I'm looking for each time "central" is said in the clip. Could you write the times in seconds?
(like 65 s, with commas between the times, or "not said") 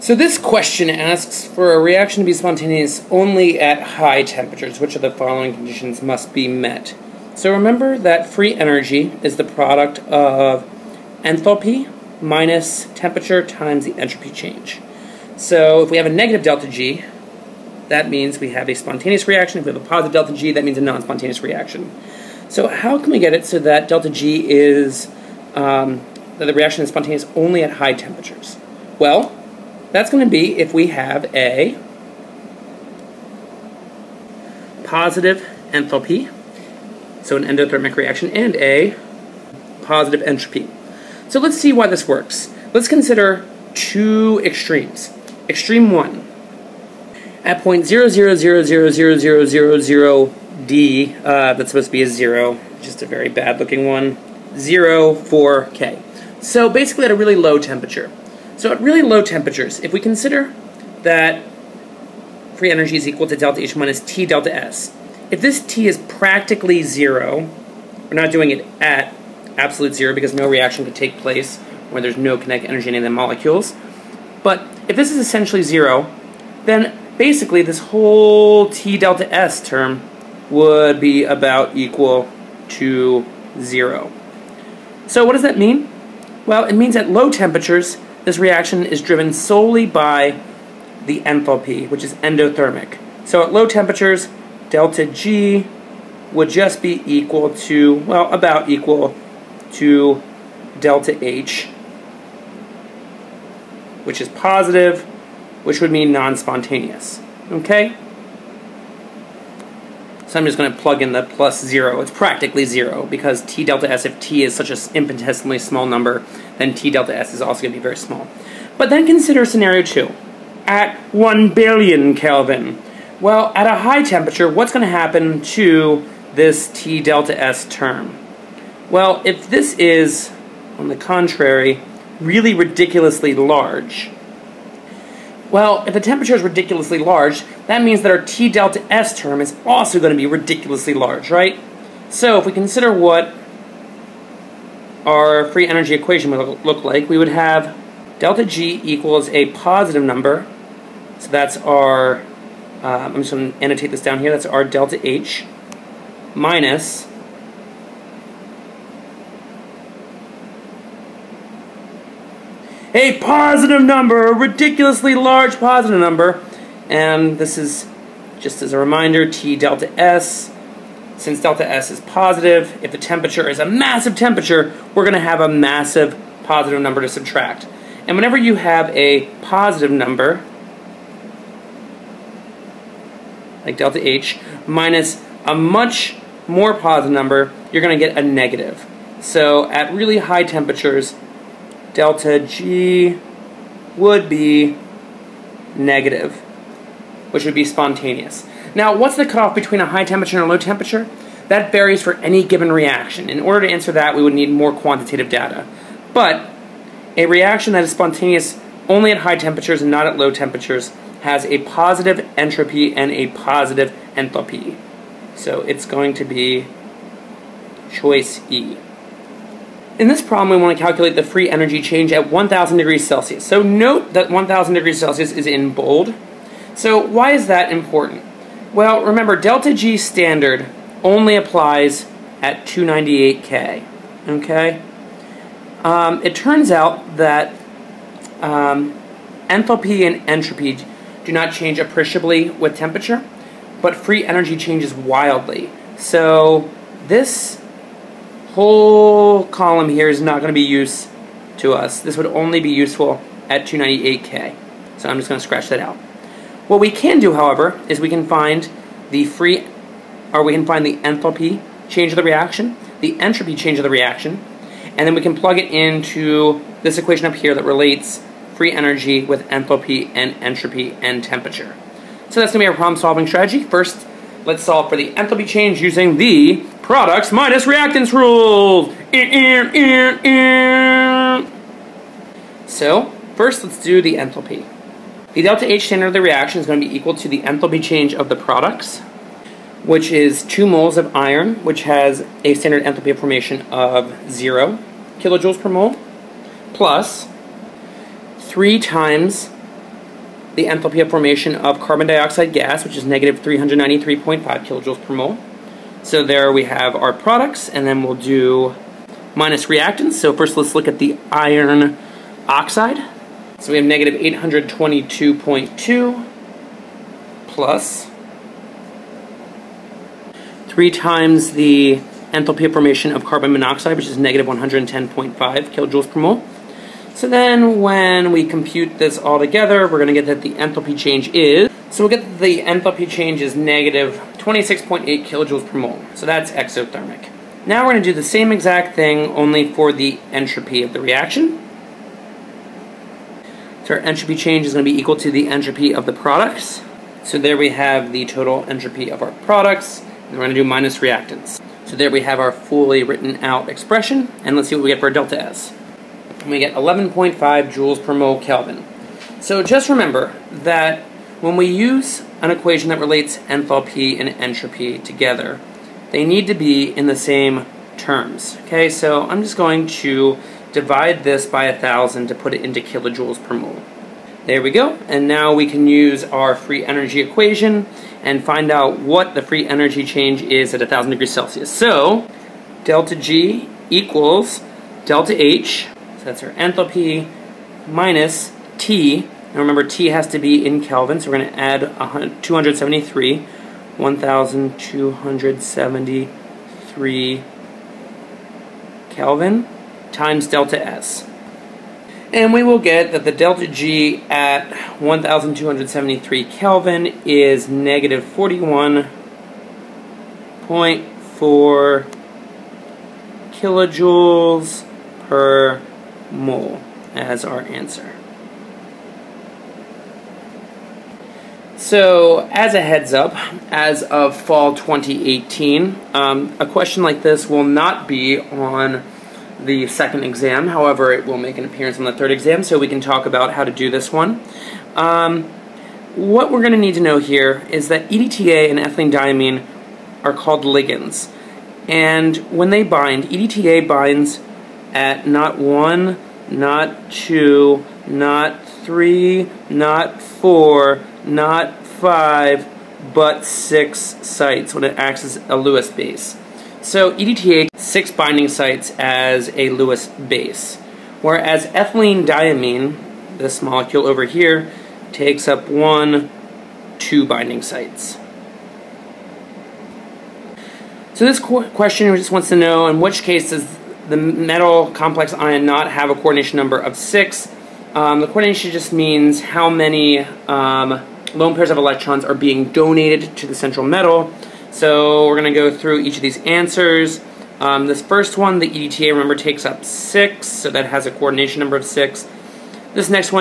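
483 s.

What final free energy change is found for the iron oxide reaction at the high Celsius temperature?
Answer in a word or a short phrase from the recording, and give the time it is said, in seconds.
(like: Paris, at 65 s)
-41.4 kJ/mol, at 407 s.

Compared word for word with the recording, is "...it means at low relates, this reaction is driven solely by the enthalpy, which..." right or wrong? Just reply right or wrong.
wrong.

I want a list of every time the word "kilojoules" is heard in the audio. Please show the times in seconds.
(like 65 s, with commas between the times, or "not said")
295 s, 304 s, 325 s, 335 s, 372 s, 413 s.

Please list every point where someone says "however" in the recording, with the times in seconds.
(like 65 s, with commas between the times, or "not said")
257 s, 430 s.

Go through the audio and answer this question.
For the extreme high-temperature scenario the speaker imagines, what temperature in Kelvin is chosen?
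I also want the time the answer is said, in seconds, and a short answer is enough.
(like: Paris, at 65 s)
1 billion Kelvin, at 121 s.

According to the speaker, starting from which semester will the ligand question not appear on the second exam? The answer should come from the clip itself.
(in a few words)
fall 2018.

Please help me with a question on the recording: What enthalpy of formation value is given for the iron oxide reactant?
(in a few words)
-822.2.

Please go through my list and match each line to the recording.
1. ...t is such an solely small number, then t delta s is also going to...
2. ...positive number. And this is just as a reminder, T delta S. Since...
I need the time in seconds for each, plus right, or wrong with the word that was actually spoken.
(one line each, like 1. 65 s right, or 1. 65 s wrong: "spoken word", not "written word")
1. 114 s wrong: "infinitesimally", not "solely"
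2. 165 s right.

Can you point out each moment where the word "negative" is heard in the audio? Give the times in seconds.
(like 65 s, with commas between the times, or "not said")
16 s, 188 s, 195 s, 303 s, 313 s, 324 s, 333 s, 407 s.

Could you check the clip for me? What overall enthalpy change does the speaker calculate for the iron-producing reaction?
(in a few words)
-26.8 kJ/mol.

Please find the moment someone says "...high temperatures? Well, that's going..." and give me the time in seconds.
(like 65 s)
27 s.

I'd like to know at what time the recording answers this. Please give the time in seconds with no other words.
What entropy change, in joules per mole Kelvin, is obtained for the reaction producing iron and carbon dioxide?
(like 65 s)
356 s.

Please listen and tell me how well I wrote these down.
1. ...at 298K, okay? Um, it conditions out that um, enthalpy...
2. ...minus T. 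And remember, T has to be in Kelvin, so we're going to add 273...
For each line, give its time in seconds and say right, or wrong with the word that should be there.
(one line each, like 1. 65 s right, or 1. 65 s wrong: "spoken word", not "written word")
1. 232 s wrong: "turns", not "conditions"
2. 387 s right.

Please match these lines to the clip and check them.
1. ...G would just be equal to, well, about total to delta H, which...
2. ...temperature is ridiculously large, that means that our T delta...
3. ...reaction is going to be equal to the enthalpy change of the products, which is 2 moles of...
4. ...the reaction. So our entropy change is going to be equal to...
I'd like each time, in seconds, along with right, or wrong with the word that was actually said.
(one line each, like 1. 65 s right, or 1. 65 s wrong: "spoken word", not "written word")
1. 95 s wrong: "equal", not "total"
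2. 136 s right
3. 286 s right
4. 340 s right.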